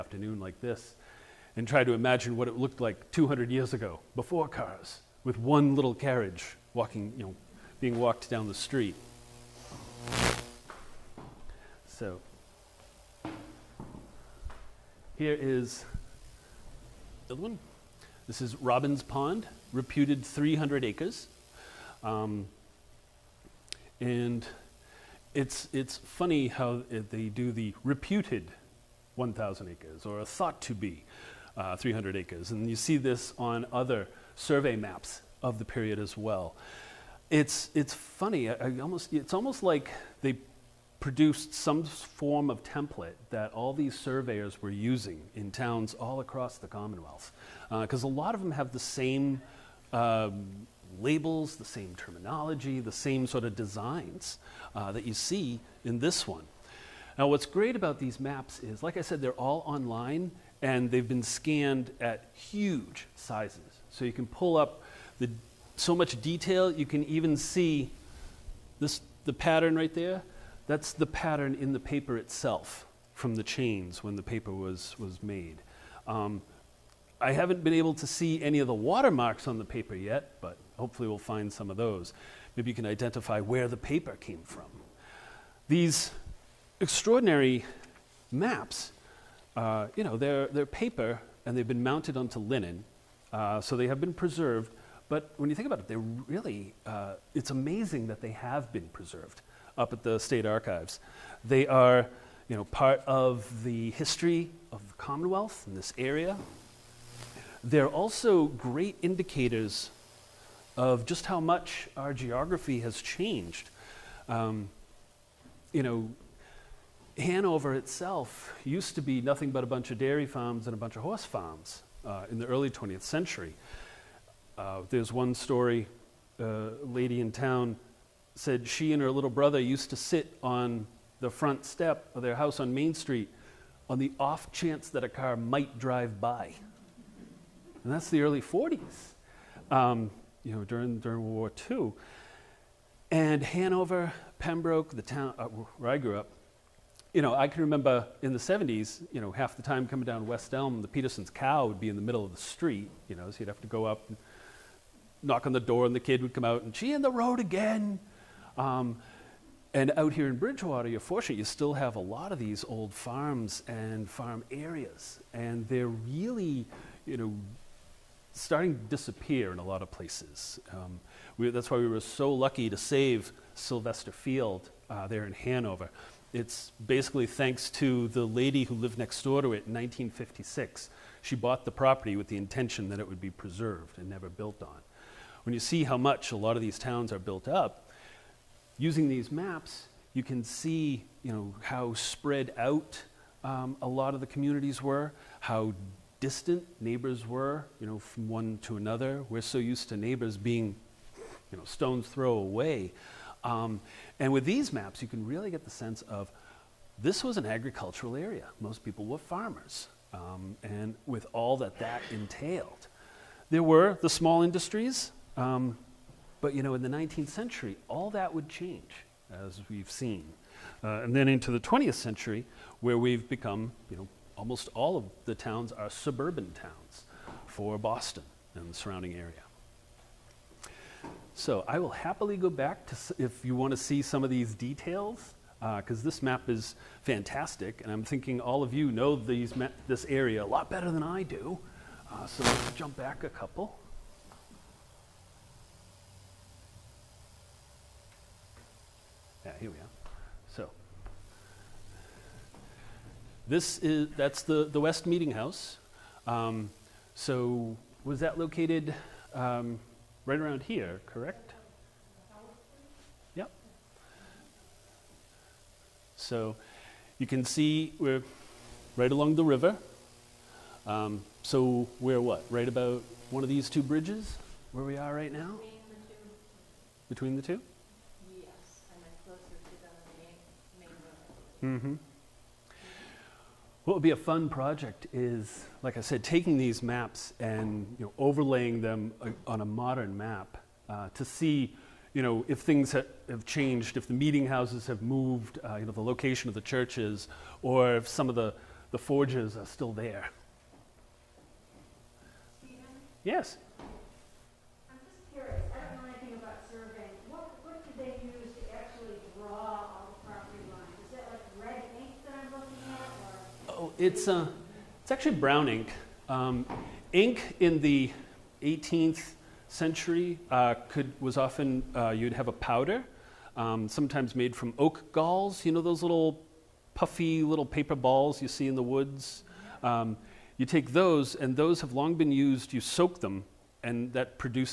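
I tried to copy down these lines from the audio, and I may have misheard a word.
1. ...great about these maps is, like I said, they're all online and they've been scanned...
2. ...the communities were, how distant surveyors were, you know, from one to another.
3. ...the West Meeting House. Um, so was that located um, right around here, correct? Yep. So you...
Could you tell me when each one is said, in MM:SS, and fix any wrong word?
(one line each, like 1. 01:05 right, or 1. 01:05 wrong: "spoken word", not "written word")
1. 00:57 right
2. 03:14 wrong: "neighbors", not "surveyors"
3. 04:14 right.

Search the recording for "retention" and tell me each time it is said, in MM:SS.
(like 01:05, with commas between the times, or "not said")
not said.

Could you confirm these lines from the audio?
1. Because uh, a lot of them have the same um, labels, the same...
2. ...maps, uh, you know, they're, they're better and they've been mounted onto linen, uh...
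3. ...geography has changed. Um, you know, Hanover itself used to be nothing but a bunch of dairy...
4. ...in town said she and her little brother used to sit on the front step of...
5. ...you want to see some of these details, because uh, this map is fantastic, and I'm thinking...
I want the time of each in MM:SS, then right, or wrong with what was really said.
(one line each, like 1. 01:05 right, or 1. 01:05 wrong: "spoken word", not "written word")
1. 00:47 right
2. 01:28 wrong: "paper", not "better"
3. 01:52 right
4. 02:07 right
5. 03:53 right.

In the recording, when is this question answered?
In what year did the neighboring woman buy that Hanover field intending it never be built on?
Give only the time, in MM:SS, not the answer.
02:59.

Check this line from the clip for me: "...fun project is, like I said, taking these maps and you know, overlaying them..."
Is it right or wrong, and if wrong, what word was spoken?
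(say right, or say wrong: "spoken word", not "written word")
right.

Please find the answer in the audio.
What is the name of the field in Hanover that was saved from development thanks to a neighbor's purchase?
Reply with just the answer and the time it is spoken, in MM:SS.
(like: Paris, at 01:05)
Sylvester Field, at 02:53.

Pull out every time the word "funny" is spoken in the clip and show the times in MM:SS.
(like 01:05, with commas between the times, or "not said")
00:25, 00:37.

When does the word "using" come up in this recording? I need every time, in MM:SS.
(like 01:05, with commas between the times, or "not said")
00:44, 03:08.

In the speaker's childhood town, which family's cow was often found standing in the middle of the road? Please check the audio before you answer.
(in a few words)
The Peterson's.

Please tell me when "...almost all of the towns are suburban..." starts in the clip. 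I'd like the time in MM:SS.
03:44.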